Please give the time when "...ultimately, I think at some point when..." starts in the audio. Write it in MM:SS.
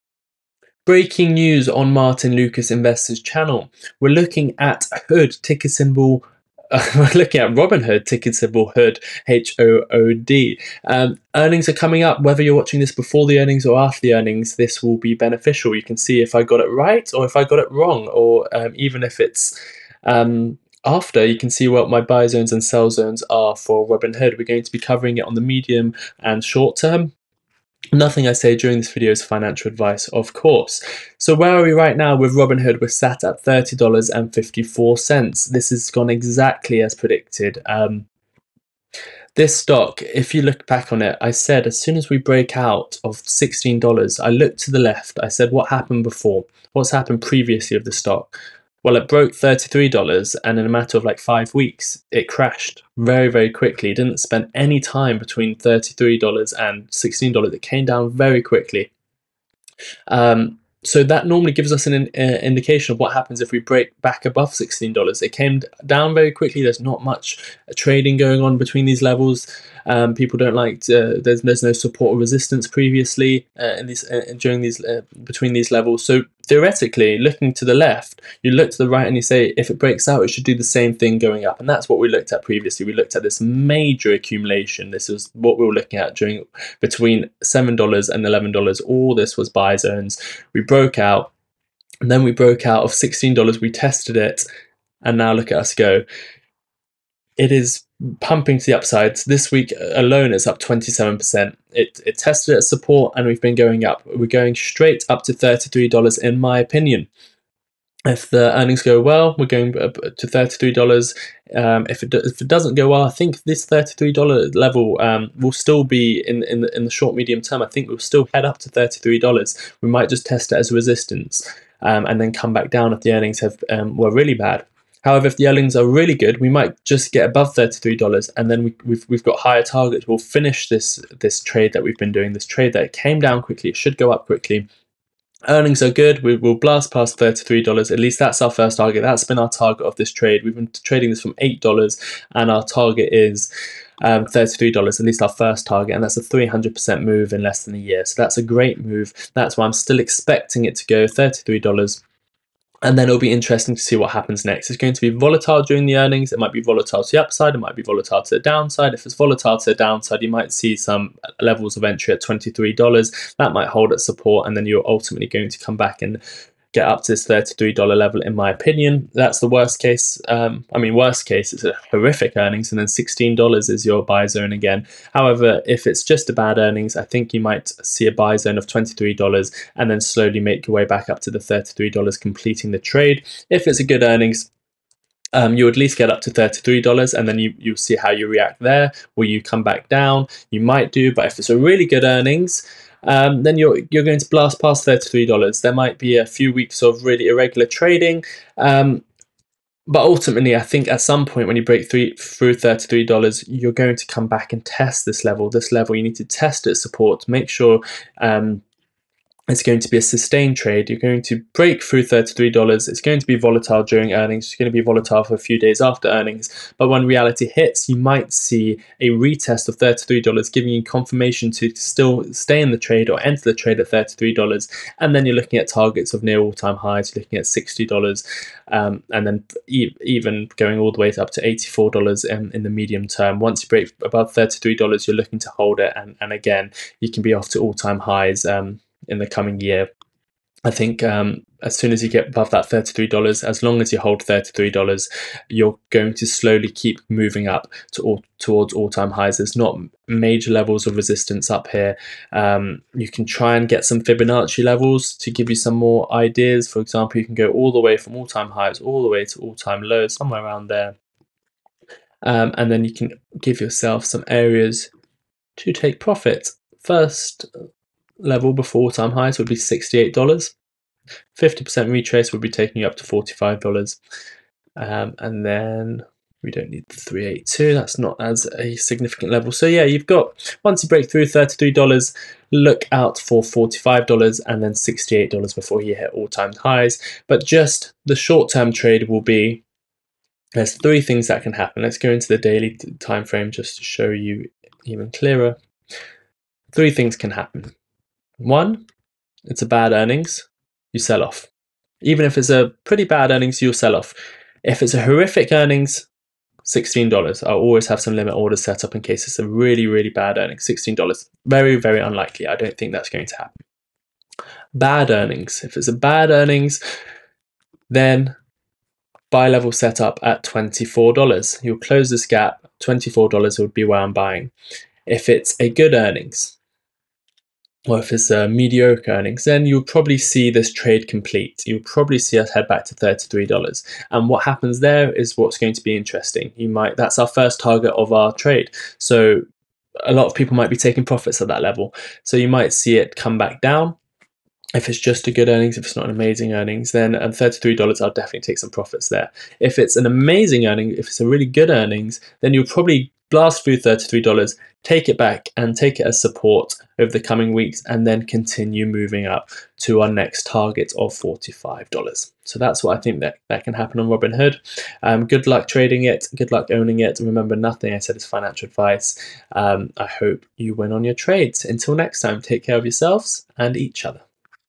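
03:20.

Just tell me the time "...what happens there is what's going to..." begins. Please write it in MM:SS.
05:34.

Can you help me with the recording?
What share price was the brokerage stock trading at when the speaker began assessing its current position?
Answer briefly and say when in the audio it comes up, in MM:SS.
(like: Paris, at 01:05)
$30.54, at 00:33.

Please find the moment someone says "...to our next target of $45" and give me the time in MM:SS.
05:59.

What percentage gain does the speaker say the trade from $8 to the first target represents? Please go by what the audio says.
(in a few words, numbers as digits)
300%.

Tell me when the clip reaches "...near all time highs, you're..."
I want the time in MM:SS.
03:46.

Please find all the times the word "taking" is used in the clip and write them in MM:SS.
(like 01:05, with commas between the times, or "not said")
04:32, 05:40.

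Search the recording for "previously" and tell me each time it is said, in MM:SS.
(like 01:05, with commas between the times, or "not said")
00:47, 01:12, 01:22.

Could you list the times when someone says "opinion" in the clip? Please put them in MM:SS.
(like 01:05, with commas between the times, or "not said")
01:46, 02:48.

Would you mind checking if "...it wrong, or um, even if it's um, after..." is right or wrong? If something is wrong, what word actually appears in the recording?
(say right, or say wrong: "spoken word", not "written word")
right.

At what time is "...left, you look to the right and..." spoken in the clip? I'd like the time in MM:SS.
01:17.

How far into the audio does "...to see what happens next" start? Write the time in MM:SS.
02:33.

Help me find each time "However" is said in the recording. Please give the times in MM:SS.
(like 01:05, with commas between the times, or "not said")
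02:05, 02:55.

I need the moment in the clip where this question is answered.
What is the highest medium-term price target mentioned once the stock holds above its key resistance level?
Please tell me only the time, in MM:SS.
03:51.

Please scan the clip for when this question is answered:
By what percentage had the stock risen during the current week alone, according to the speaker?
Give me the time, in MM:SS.
01:40.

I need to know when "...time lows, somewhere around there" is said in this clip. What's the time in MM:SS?
04:19.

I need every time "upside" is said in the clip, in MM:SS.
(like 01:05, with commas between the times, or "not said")
01:38, 02:37.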